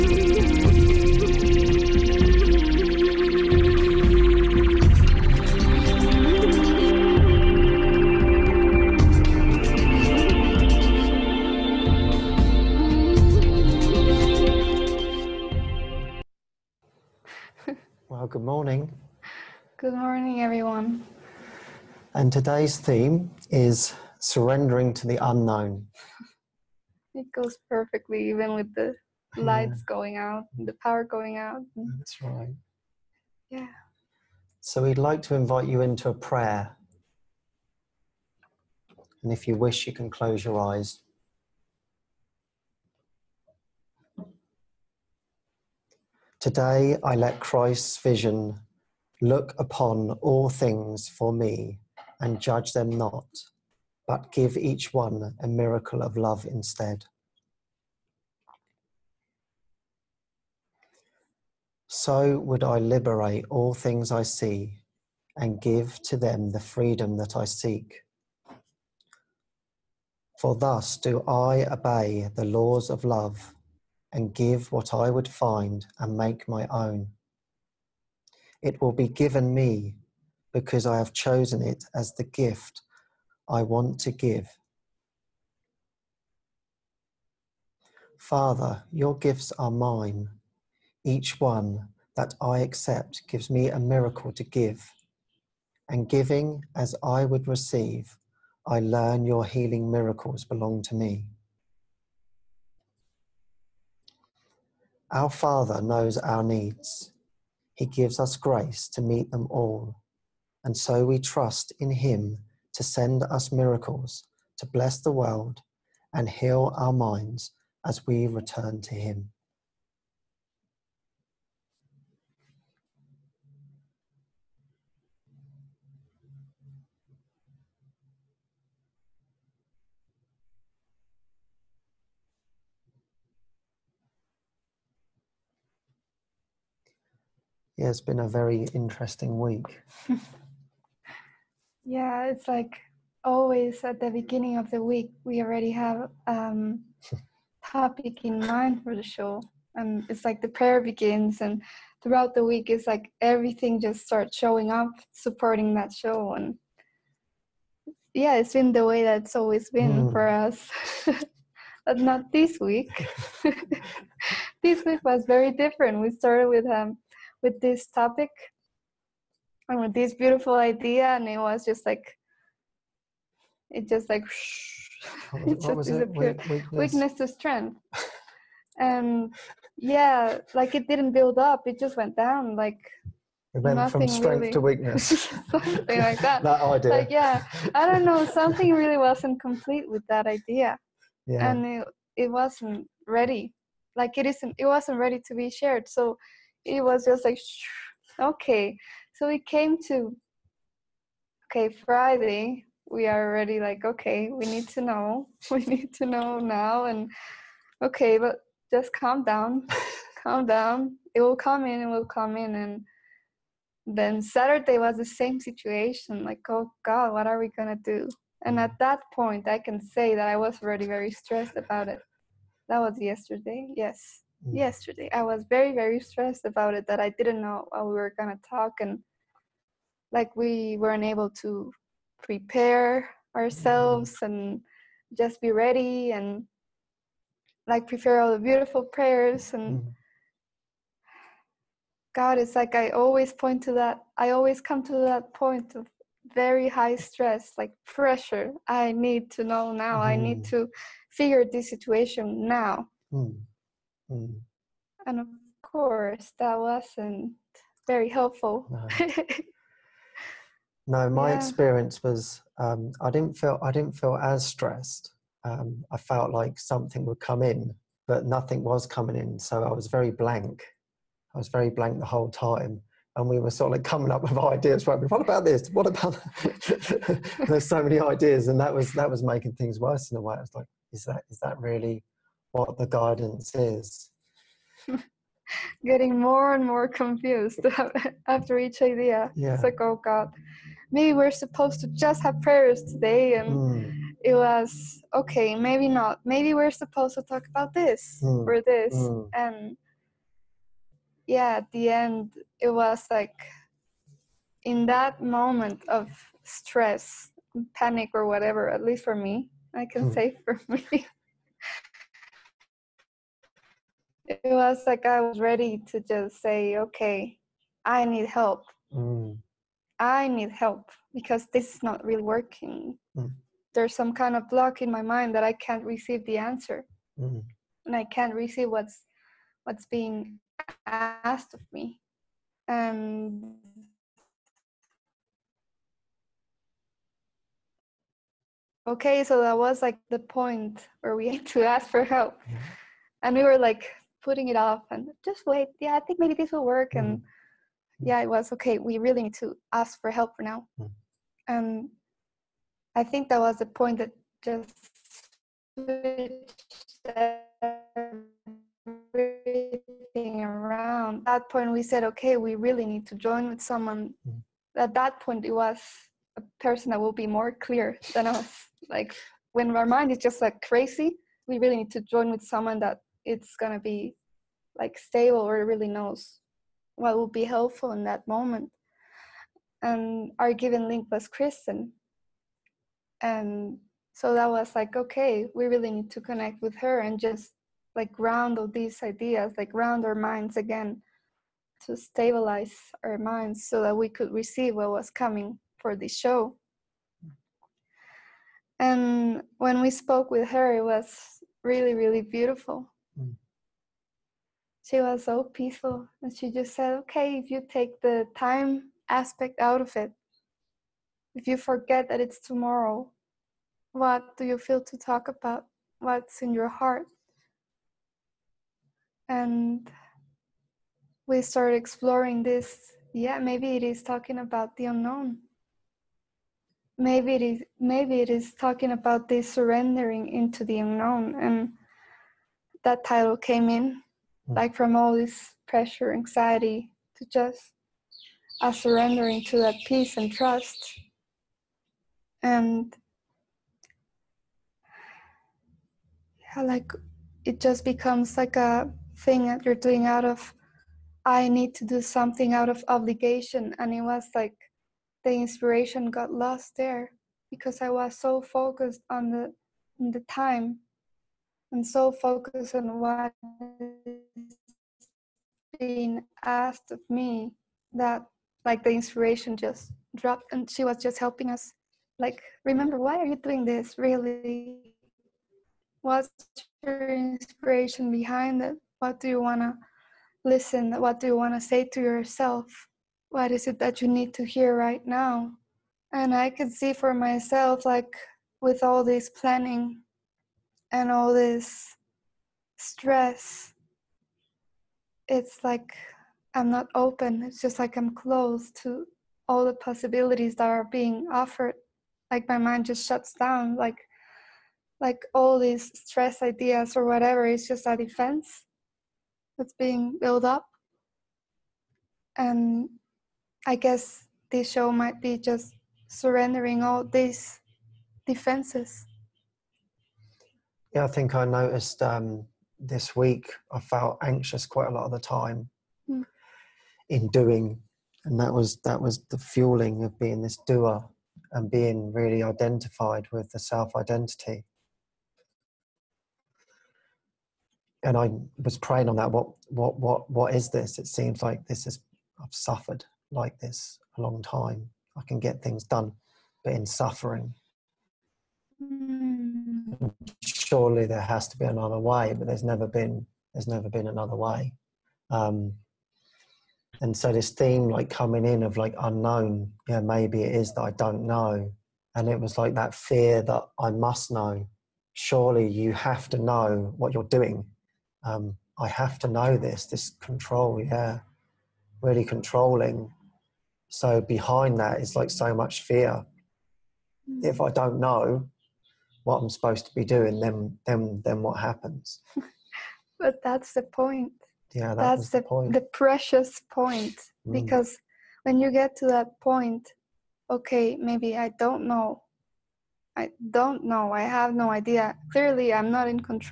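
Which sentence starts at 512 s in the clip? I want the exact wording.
And I guess this show might be just surrendering all these defenses.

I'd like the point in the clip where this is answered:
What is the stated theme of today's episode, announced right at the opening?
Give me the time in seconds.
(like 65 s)
24 s.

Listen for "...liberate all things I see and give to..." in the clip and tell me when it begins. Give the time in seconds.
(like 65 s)
62 s.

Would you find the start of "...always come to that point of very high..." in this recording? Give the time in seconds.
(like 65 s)
244 s.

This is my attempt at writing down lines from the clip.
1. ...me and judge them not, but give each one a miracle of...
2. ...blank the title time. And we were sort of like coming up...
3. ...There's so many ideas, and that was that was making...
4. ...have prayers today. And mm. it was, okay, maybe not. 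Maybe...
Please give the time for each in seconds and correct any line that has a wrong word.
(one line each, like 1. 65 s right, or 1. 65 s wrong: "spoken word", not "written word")
1. 51 s right
2. 271 s wrong: "whole", not "title"
3. 277 s right
4. 292 s right.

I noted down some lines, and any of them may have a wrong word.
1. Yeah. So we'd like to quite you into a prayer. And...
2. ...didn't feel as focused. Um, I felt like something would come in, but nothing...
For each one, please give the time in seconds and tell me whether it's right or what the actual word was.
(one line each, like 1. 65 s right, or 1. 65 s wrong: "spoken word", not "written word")
1. 33 s wrong: "invite", not "quite"
2. 263 s wrong: "stressed", not "focused".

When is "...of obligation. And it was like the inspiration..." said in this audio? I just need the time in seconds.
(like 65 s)
452 s.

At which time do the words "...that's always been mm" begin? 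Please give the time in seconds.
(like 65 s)
159 s.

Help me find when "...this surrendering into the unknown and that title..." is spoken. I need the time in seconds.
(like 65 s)
429 s.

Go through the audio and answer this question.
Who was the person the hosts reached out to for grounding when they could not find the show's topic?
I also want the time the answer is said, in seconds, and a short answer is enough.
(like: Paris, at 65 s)
Kristen, at 381 s.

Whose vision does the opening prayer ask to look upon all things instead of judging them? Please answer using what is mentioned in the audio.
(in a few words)
Christ's.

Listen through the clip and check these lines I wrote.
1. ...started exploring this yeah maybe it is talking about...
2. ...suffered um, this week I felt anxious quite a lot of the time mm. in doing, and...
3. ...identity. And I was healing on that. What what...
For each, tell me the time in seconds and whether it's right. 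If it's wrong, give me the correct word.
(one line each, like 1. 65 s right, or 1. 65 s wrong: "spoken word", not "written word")
1. 421 s right
2. 521 s wrong: "noticed", not "suffered"
3. 533 s wrong: "praying", not "healing".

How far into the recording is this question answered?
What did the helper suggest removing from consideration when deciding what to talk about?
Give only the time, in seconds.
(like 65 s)
408 s.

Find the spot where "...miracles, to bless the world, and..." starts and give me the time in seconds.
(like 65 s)
113 s.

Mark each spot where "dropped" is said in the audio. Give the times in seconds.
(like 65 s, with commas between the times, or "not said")
470 s.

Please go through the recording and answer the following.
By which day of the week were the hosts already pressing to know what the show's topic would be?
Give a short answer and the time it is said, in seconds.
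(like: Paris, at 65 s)
Friday, at 201 s.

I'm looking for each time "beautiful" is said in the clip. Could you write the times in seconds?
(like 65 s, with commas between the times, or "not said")
170 s, 238 s, 402 s.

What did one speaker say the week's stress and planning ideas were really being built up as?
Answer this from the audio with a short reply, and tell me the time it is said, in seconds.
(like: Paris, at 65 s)
A defense, at 507 s.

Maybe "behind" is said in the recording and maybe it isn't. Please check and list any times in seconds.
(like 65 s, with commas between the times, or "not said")
478 s, 574 s.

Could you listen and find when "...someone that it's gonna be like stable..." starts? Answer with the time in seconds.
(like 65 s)
372 s.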